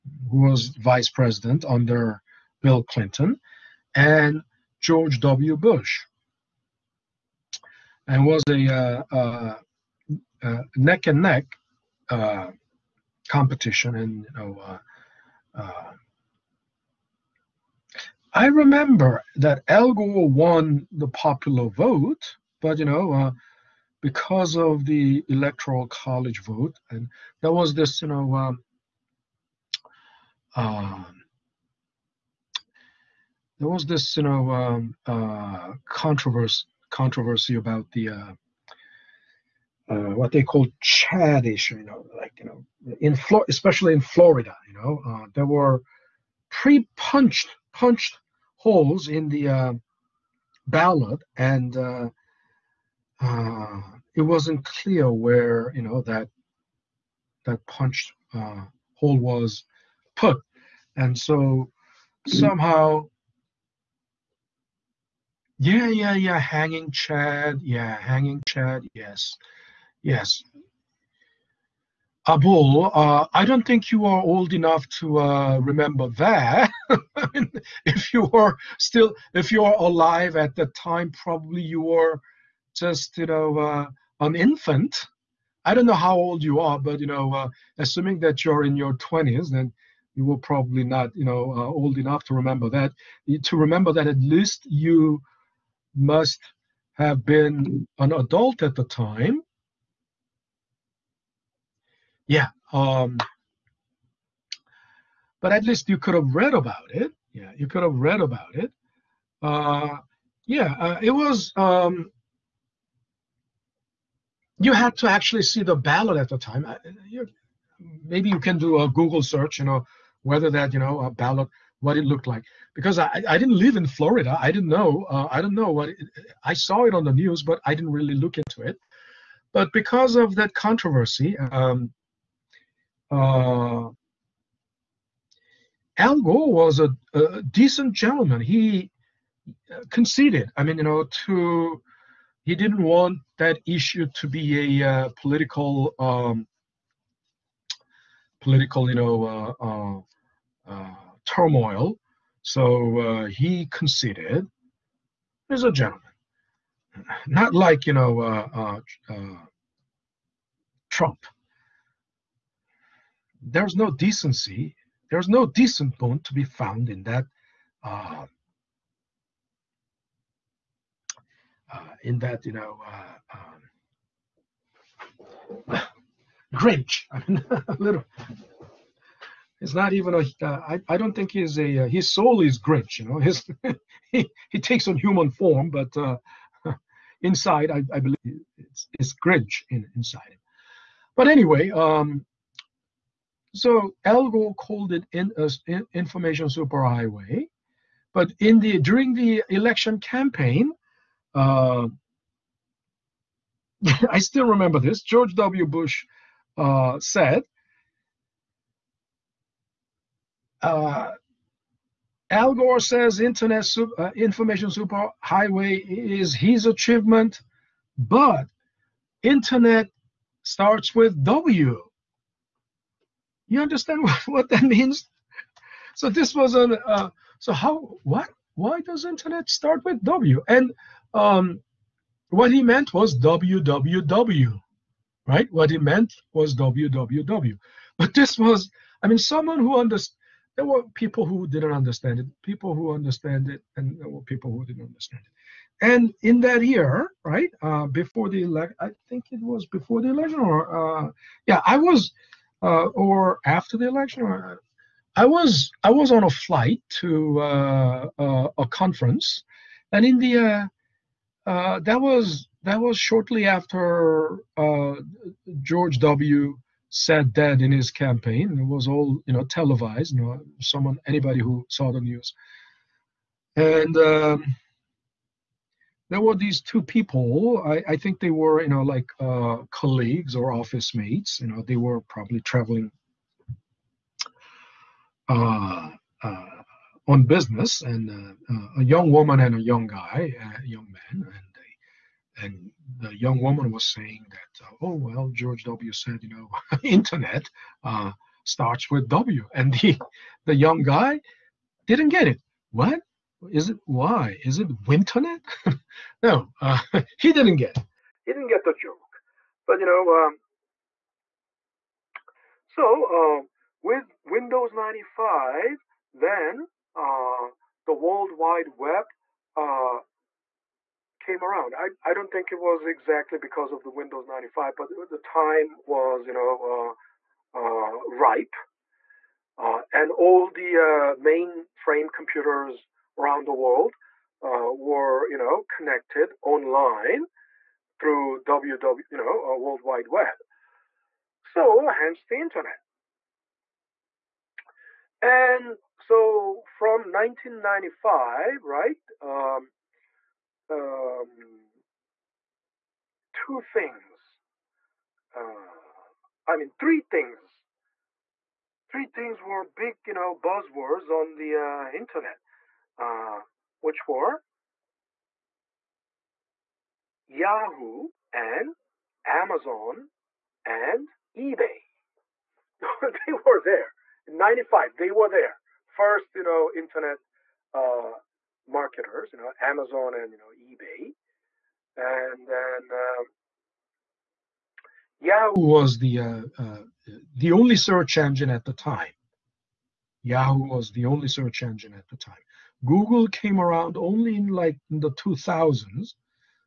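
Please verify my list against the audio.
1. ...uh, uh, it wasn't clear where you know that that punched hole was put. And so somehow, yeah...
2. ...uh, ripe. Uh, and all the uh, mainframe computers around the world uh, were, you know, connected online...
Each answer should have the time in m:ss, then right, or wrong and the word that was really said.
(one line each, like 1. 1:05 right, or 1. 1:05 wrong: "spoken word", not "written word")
1. 0:51 right
2. 5:27 right.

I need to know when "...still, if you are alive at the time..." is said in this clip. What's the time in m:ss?
1:18.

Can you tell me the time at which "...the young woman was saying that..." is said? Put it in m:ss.
4:53.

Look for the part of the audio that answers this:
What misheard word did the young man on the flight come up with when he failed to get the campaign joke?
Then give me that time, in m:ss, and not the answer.
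5:04.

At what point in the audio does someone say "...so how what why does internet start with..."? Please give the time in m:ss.
3:47.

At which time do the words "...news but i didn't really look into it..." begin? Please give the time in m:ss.
2:07.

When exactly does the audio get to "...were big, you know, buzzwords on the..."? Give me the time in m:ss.
5:59.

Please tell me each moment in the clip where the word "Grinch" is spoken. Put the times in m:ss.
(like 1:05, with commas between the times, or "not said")
2:56, 3:02, 3:09.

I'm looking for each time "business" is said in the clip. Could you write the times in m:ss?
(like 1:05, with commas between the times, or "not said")
4:47.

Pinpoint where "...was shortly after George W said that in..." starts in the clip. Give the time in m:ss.
4:22.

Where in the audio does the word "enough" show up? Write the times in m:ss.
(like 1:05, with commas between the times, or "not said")
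1:14, 1:31.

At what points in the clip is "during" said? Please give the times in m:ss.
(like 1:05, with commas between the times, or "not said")
3:18.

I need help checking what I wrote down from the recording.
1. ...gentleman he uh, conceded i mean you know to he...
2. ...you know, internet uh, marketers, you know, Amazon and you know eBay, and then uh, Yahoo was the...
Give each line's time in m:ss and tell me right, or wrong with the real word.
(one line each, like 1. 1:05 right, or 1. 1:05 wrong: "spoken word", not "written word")
1. 2:17 right
2. 6:16 right.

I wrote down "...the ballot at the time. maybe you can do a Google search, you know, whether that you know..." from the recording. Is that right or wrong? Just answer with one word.
right.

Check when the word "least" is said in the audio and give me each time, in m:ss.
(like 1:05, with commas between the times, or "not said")
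1:34, 1:45.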